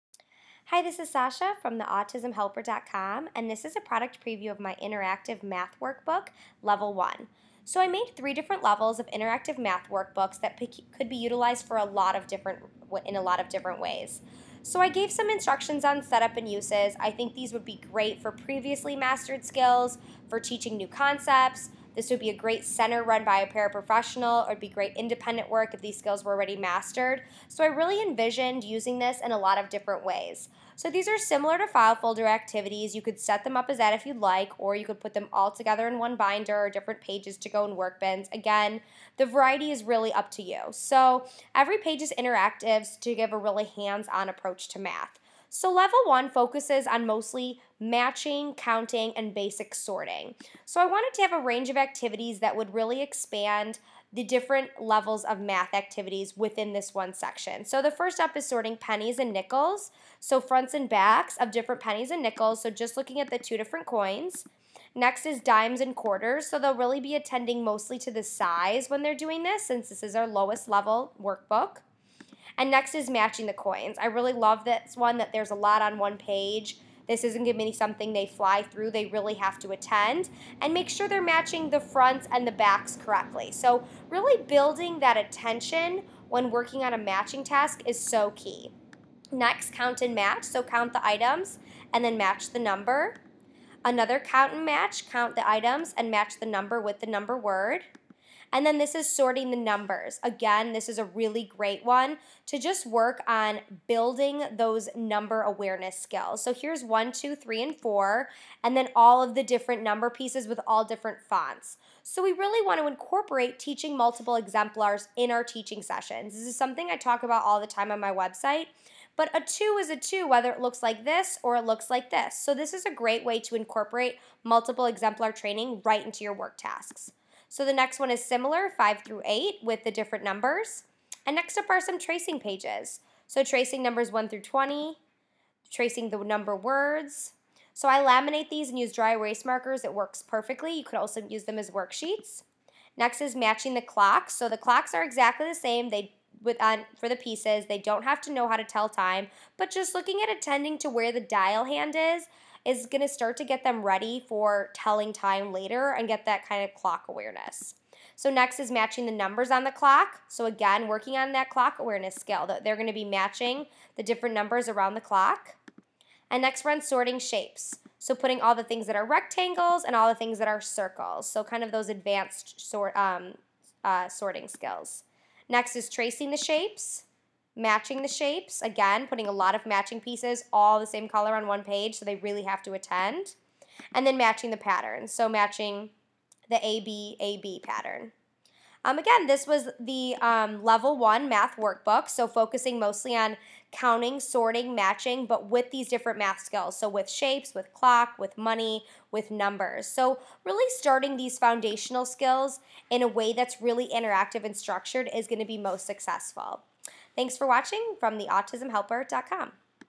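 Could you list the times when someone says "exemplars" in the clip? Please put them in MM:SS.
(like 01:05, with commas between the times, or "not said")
01:54, 02:04.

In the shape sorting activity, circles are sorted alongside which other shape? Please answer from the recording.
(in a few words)
rectangles.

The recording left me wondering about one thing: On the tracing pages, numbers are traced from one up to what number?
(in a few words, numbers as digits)
20.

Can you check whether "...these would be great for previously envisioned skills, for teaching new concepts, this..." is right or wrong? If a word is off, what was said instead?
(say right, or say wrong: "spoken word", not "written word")
wrong: "mastered", not "envisioned".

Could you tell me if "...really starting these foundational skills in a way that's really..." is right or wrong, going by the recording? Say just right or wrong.
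right.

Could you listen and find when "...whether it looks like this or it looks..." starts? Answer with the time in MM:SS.
02:00.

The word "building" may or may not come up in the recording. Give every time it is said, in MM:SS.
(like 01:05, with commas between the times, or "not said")
01:24, 01:43.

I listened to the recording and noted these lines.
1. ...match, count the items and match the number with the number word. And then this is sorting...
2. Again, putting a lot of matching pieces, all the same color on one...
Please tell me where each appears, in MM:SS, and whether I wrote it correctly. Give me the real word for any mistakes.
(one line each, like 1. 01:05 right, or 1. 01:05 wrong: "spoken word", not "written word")
1. 01:34 right
2. 02:58 right.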